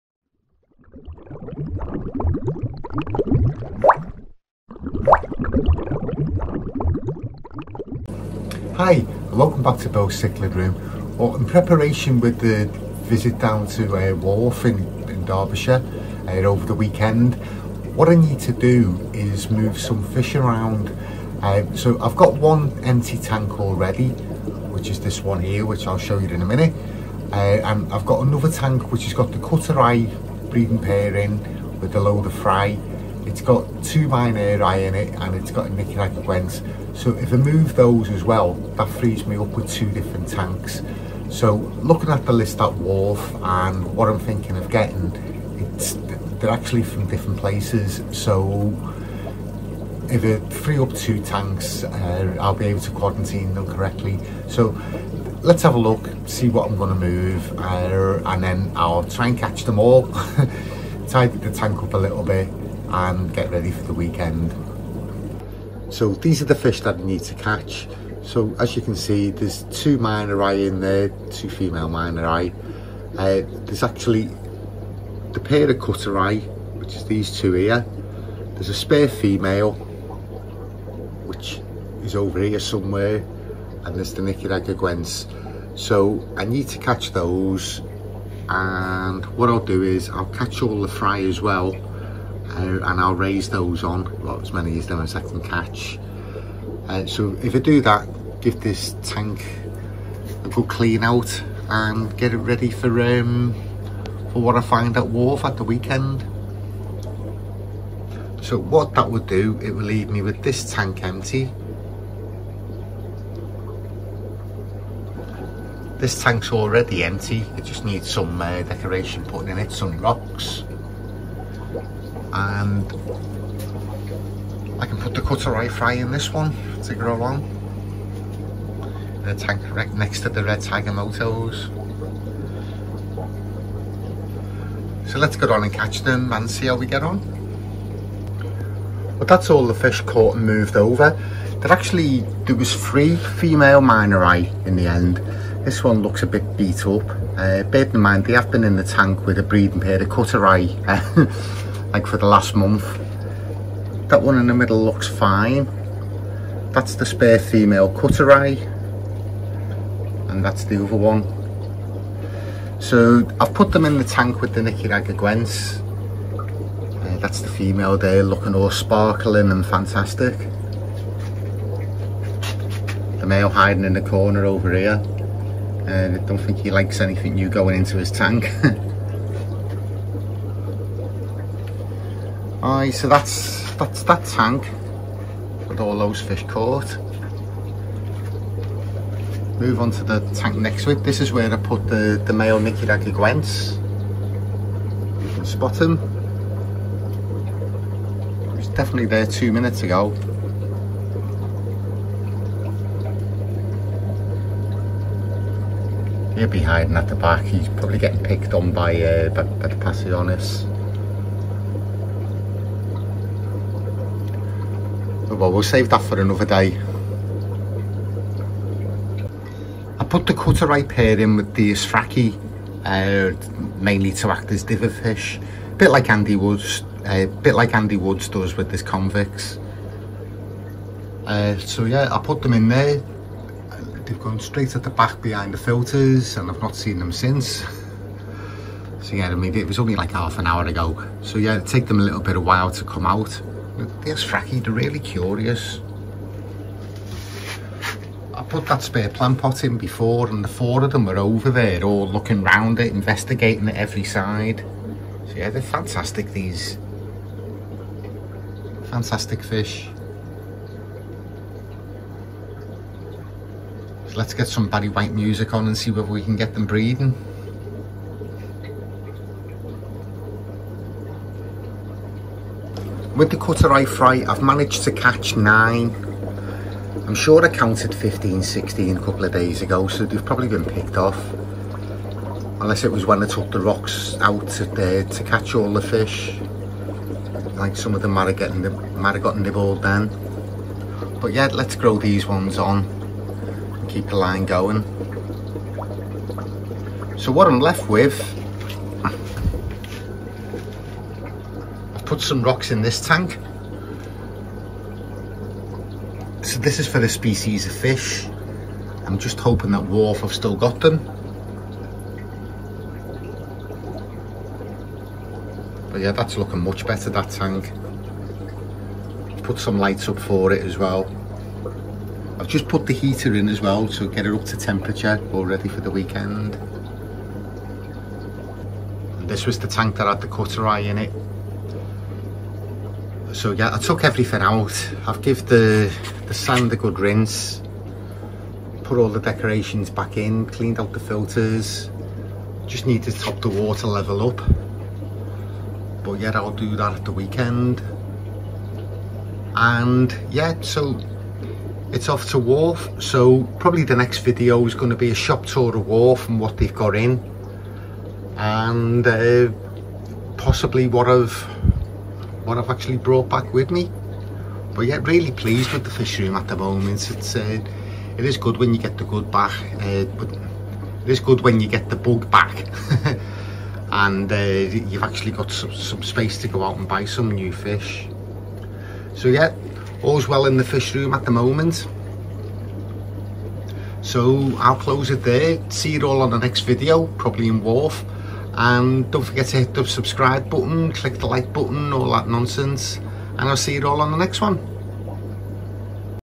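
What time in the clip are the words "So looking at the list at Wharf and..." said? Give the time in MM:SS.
00:41.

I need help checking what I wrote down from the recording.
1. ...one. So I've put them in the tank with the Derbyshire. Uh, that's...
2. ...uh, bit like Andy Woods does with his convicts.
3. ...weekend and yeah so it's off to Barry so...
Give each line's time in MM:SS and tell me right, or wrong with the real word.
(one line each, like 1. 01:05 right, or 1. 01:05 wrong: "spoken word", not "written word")
1. 02:40 wrong: "Nicaraguense", not "Derbyshire"
2. 03:47 right
3. 05:47 wrong: "Wharf", not "Barry".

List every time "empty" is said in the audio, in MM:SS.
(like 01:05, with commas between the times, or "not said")
00:22, 01:51, 01:57.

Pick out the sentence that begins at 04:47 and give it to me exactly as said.
Like some of them might have, gotten might have got nibbled then.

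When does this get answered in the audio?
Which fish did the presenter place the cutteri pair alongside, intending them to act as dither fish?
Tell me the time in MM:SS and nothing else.
03:41.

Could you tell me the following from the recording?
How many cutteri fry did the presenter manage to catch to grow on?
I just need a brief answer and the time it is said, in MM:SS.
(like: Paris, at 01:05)
9, at 04:35.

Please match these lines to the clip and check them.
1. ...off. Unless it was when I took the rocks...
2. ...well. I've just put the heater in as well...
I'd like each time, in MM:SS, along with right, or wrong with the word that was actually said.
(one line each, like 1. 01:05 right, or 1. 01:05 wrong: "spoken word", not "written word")
1. 04:40 right
2. 05:20 right.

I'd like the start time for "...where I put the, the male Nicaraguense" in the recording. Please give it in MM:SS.
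03:11.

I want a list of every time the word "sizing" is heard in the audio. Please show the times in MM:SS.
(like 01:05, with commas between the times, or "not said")
not said.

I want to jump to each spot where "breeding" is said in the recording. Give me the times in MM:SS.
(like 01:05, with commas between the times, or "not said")
00:30, 02:29, 04:26.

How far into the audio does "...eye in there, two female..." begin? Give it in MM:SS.
01:10.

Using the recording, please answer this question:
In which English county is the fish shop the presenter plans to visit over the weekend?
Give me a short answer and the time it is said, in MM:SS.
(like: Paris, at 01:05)
Derbyshire, at 00:15.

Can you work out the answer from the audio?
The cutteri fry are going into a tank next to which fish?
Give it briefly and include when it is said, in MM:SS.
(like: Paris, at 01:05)
red tiger motos, at 02:10.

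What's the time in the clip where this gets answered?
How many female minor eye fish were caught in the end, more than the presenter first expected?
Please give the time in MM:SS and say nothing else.
02:22.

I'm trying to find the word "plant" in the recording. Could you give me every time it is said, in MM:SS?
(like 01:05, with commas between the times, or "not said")
04:09.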